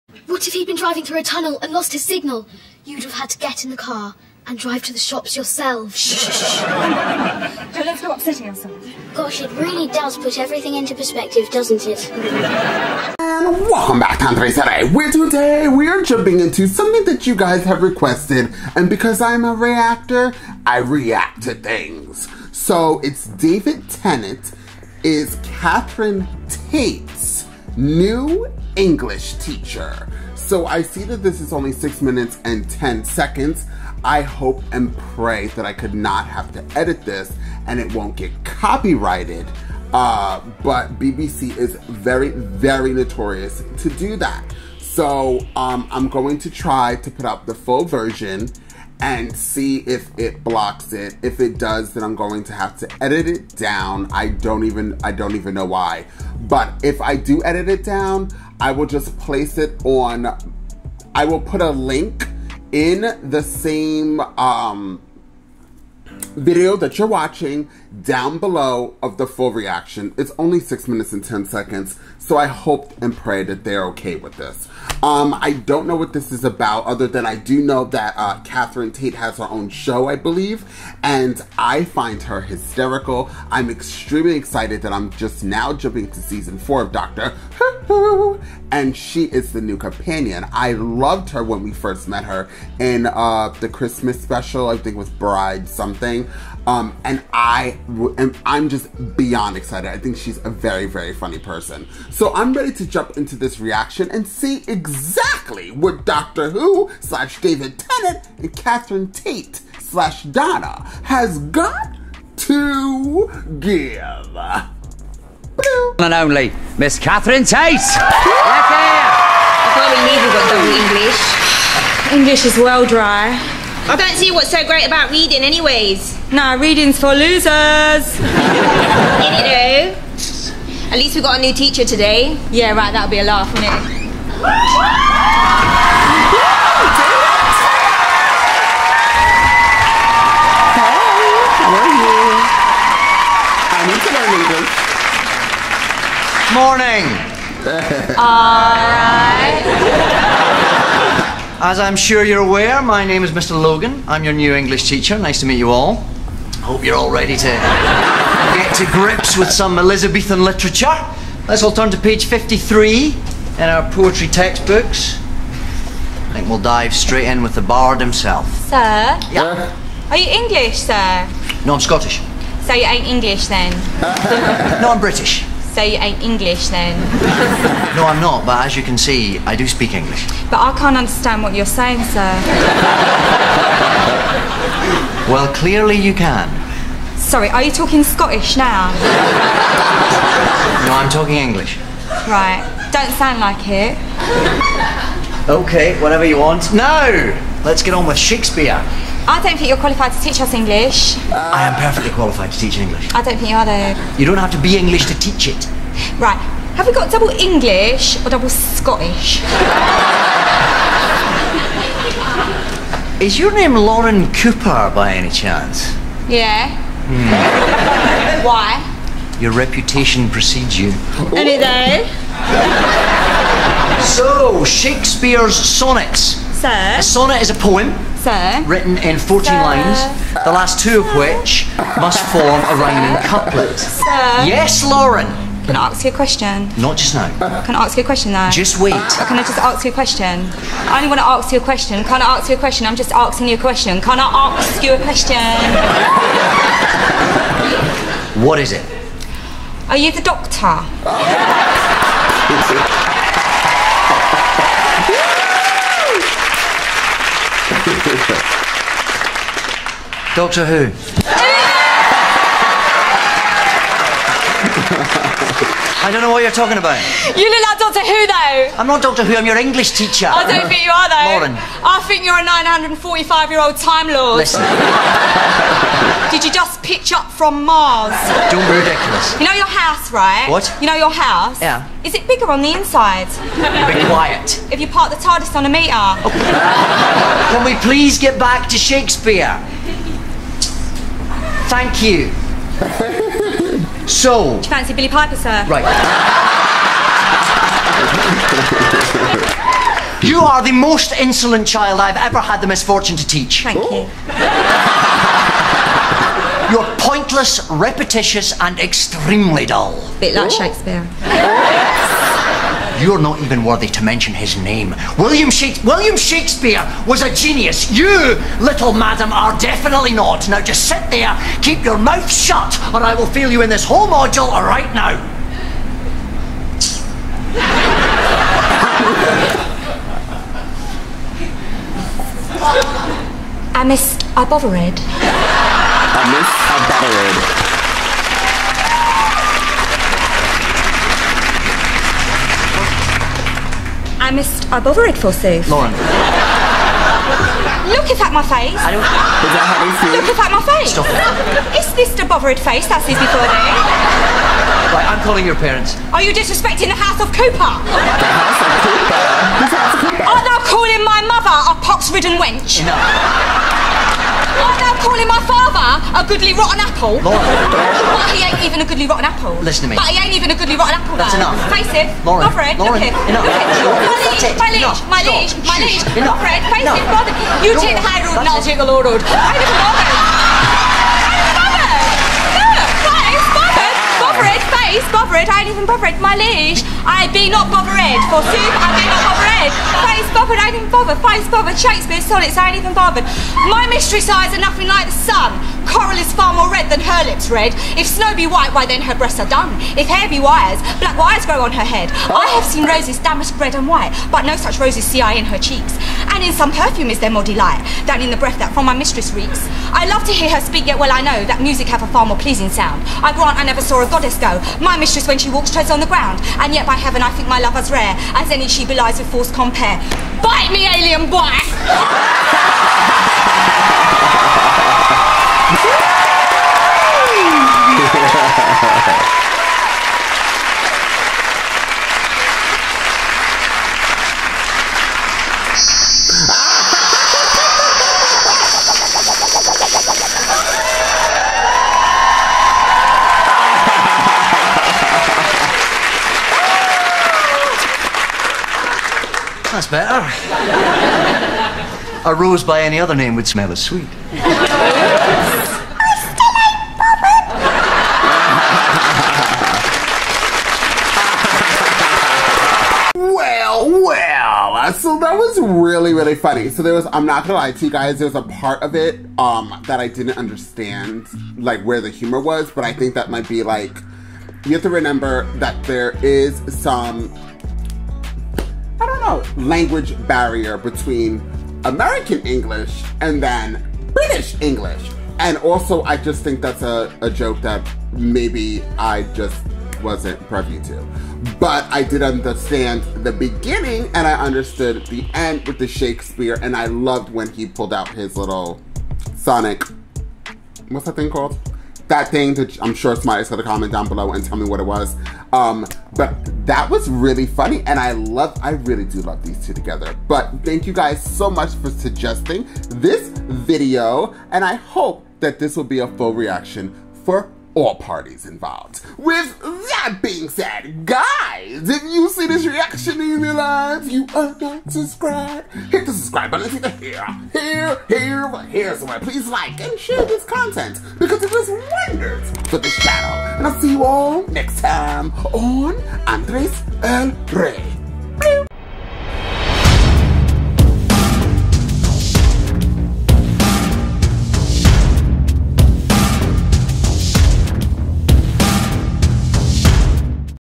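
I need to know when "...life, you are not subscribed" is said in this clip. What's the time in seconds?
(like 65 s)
523 s.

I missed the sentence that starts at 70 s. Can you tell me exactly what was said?
It's only six minutes and 10 seconds, so I hope and pray that they're okay with this.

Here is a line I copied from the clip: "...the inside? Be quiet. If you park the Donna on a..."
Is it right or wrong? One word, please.
wrong.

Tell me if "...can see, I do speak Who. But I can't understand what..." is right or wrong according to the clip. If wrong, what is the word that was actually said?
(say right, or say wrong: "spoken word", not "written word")
wrong: "English", not "Who".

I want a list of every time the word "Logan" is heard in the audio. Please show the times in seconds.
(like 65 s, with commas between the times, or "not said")
153 s.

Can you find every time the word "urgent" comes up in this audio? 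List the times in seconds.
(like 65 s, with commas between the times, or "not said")
not said.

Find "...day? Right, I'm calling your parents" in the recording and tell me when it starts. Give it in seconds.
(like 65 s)
353 s.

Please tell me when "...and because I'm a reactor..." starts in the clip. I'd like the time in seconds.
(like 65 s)
18 s.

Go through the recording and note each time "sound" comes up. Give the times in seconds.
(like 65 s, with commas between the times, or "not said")
193 s, 412 s.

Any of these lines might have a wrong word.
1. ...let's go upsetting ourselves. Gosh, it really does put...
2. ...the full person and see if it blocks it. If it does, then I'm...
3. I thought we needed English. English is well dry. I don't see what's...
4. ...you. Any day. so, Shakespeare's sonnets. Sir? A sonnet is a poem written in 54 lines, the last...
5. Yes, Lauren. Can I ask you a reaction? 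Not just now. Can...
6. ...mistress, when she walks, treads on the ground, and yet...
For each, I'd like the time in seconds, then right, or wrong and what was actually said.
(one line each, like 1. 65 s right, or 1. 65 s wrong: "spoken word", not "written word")
1. 7 s right
2. 47 s wrong: "version", not "person"
3. 119 s right
4. 220 s wrong: "14", not "54"
5. 234 s wrong: "question", not "reaction"
6. 414 s right.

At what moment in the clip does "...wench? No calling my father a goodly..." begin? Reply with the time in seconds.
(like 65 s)
362 s.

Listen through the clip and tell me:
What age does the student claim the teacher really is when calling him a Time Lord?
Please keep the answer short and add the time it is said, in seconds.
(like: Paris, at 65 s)
945, at 272 s.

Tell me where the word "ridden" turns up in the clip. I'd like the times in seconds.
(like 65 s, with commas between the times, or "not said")
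361 s.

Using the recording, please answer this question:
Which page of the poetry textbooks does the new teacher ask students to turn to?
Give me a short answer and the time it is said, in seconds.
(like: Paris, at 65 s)
Page 53, at 161 s.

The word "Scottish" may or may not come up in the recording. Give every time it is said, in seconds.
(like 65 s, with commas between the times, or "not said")
171 s, 188 s, 208 s.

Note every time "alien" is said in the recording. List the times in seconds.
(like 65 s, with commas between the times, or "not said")
420 s.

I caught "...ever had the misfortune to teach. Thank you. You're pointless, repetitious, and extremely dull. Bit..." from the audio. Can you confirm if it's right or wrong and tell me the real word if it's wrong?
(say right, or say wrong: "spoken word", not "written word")
right.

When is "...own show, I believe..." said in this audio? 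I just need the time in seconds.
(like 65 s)
79 s.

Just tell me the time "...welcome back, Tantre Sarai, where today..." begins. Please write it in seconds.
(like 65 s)
13 s.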